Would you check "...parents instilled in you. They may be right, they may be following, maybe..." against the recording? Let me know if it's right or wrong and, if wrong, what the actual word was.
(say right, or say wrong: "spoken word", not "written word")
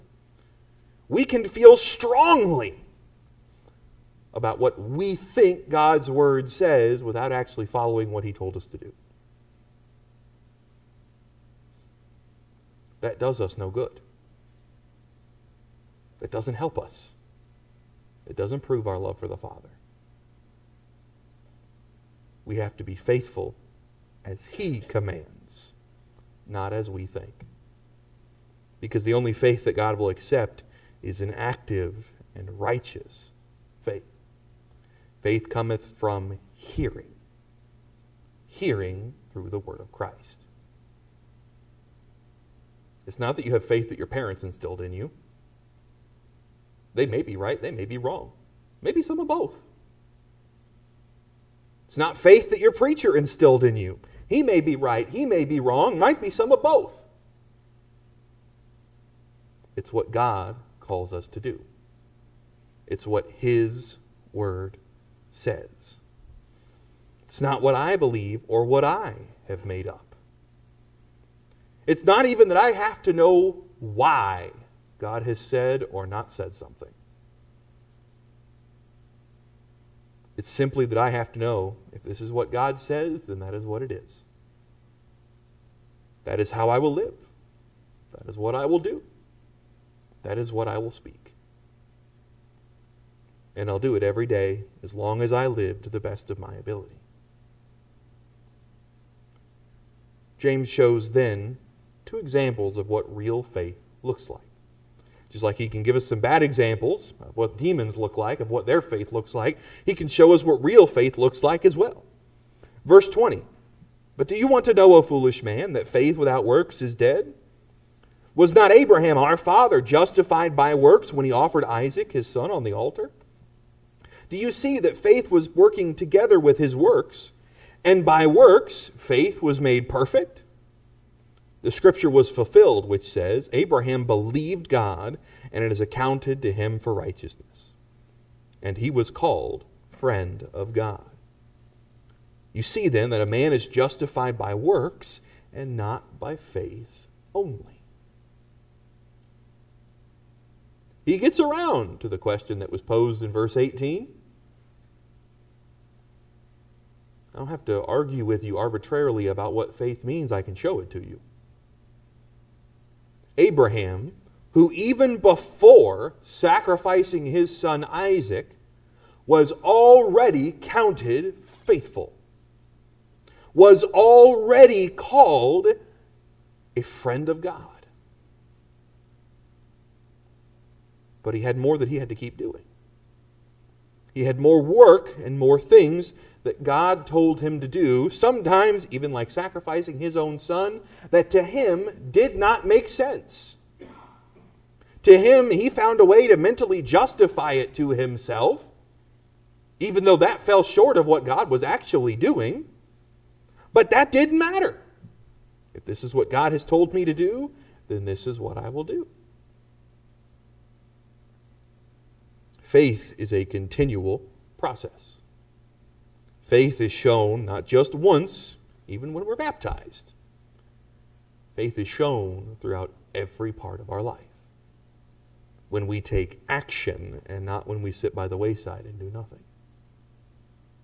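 wrong: "wrong", not "following".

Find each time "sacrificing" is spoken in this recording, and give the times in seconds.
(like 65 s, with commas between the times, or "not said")
166 s, 189 s.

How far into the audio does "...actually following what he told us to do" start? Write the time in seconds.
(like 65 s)
7 s.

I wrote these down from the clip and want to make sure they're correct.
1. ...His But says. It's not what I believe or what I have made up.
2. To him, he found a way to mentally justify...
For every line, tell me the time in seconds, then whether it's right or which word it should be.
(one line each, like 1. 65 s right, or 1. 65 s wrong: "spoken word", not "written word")
1. 63 s wrong: "Word", not "But"
2. 195 s right.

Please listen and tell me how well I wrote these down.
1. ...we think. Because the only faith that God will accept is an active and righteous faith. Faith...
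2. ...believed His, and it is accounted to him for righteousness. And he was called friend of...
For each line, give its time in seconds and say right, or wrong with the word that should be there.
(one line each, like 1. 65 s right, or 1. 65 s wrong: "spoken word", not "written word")
1. 26 s right
2. 134 s wrong: "God", not "His".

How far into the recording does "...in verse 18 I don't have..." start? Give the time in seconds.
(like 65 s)
153 s.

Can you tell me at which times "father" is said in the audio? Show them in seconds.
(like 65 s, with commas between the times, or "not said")
19 s, 119 s.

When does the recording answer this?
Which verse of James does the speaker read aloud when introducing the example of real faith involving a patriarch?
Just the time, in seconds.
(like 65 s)
112 s.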